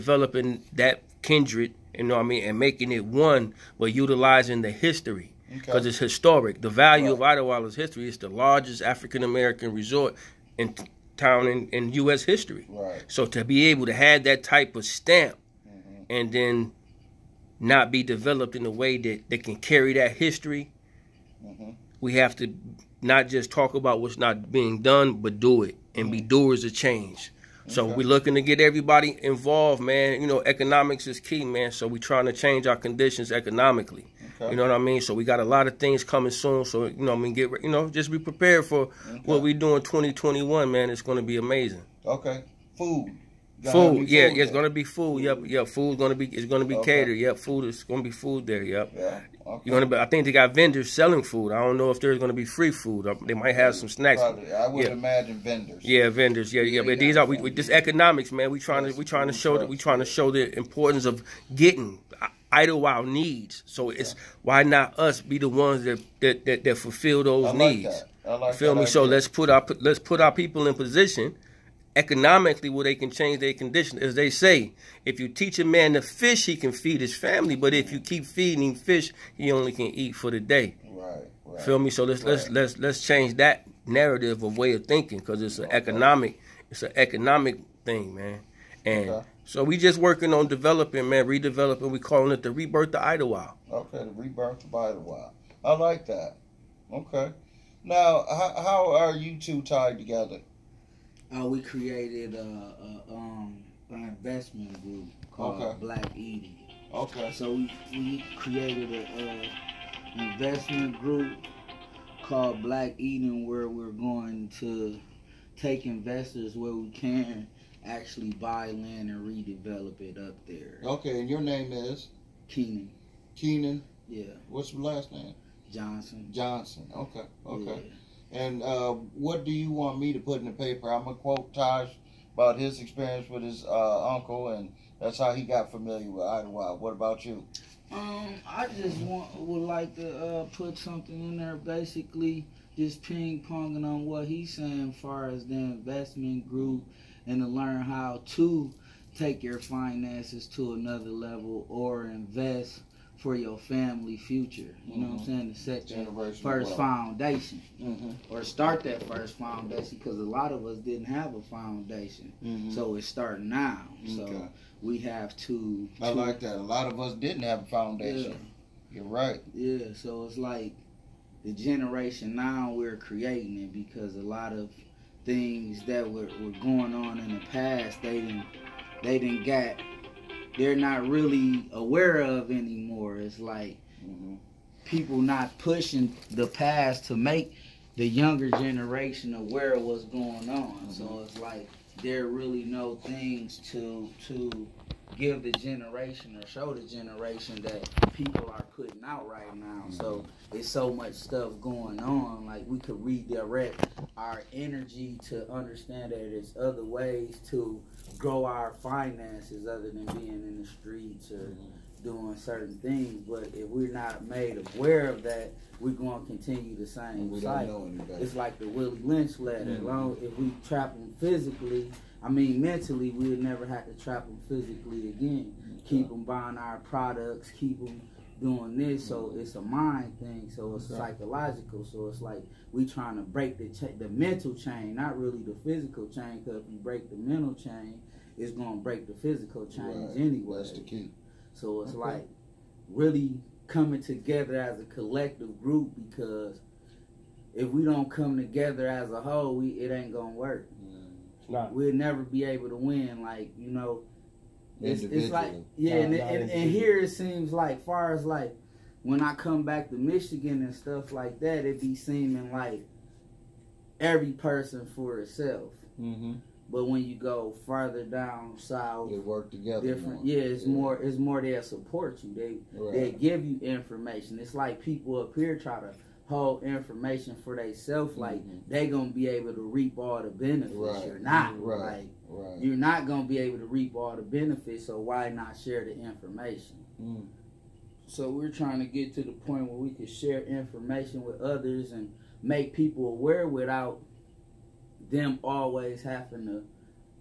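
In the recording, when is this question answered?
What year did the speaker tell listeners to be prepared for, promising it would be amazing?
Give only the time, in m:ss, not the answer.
0:39.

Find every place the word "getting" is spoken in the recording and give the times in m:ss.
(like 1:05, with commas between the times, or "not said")
1:01.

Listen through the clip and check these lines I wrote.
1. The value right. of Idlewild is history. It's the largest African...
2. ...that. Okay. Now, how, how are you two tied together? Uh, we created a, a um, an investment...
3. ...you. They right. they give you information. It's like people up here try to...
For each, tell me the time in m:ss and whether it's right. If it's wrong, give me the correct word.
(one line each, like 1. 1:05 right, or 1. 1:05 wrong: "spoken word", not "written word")
1. 0:06 right
2. 1:36 right
3. 4:32 right.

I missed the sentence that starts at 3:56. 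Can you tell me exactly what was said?
Because if you break the mental chain, it's gonna break the physical chain right.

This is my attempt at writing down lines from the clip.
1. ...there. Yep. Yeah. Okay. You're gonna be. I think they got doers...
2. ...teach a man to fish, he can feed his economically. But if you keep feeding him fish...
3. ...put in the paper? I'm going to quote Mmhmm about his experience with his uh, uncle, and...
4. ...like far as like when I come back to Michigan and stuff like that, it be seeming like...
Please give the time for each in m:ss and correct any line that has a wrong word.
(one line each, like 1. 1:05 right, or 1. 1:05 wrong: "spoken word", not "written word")
1. 0:48 wrong: "vendors", not "doers"
2. 1:15 wrong: "family", not "economically"
3. 2:10 wrong: "Taj", not "Mmhmm"
4. 4:17 right.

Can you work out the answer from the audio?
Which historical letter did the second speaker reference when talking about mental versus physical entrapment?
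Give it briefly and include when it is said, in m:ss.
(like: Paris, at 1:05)
Willie Lynch letter, at 3:38.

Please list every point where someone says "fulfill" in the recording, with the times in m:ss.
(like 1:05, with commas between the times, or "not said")
1:06.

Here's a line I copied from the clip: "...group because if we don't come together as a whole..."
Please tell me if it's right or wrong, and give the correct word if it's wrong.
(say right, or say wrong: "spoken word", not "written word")
right.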